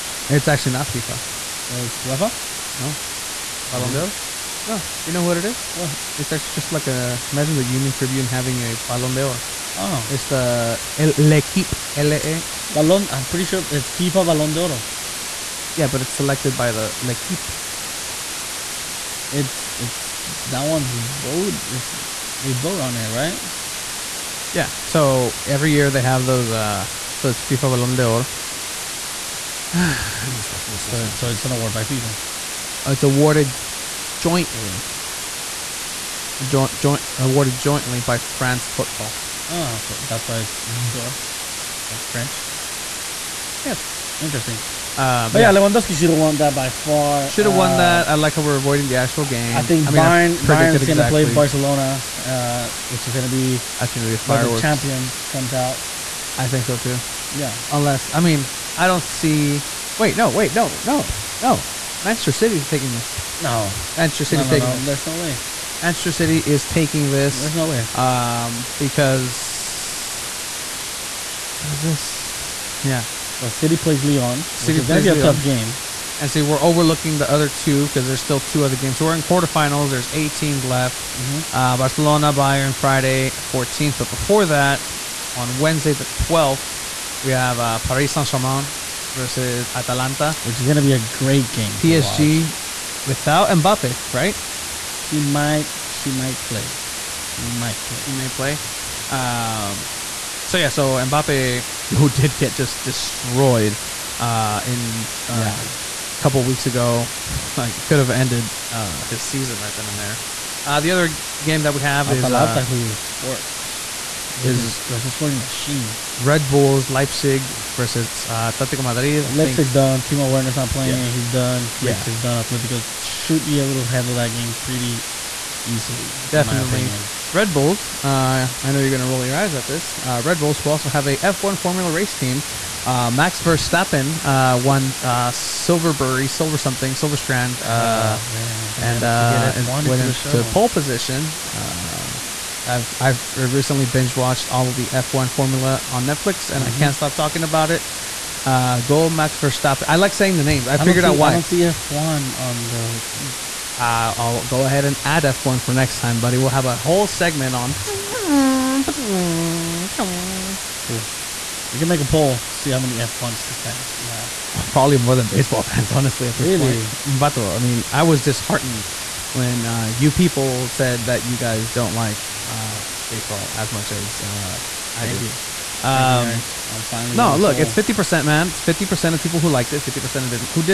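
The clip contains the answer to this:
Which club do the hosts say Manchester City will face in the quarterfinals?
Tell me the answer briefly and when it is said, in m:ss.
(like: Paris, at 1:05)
Leon, at 1:14.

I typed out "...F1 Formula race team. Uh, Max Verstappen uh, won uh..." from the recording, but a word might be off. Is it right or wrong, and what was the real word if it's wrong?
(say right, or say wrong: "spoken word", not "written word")
right.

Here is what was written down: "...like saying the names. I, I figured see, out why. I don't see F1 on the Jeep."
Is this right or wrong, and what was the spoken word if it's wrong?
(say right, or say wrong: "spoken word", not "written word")
right.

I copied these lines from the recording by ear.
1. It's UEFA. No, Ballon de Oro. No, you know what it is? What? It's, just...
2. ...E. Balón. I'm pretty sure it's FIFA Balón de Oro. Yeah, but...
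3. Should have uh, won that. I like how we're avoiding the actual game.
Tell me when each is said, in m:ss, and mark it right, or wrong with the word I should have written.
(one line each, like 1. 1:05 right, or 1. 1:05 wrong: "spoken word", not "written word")
1. 0:01 right
2. 0:12 right
3. 0:47 right.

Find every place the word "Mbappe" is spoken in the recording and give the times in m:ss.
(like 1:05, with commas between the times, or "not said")
1:33, 1:40.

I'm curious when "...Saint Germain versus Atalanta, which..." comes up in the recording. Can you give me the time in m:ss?
1:28.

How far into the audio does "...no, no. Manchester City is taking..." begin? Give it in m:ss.
1:00.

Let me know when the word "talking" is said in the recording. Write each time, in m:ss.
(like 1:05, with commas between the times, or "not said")
2:27.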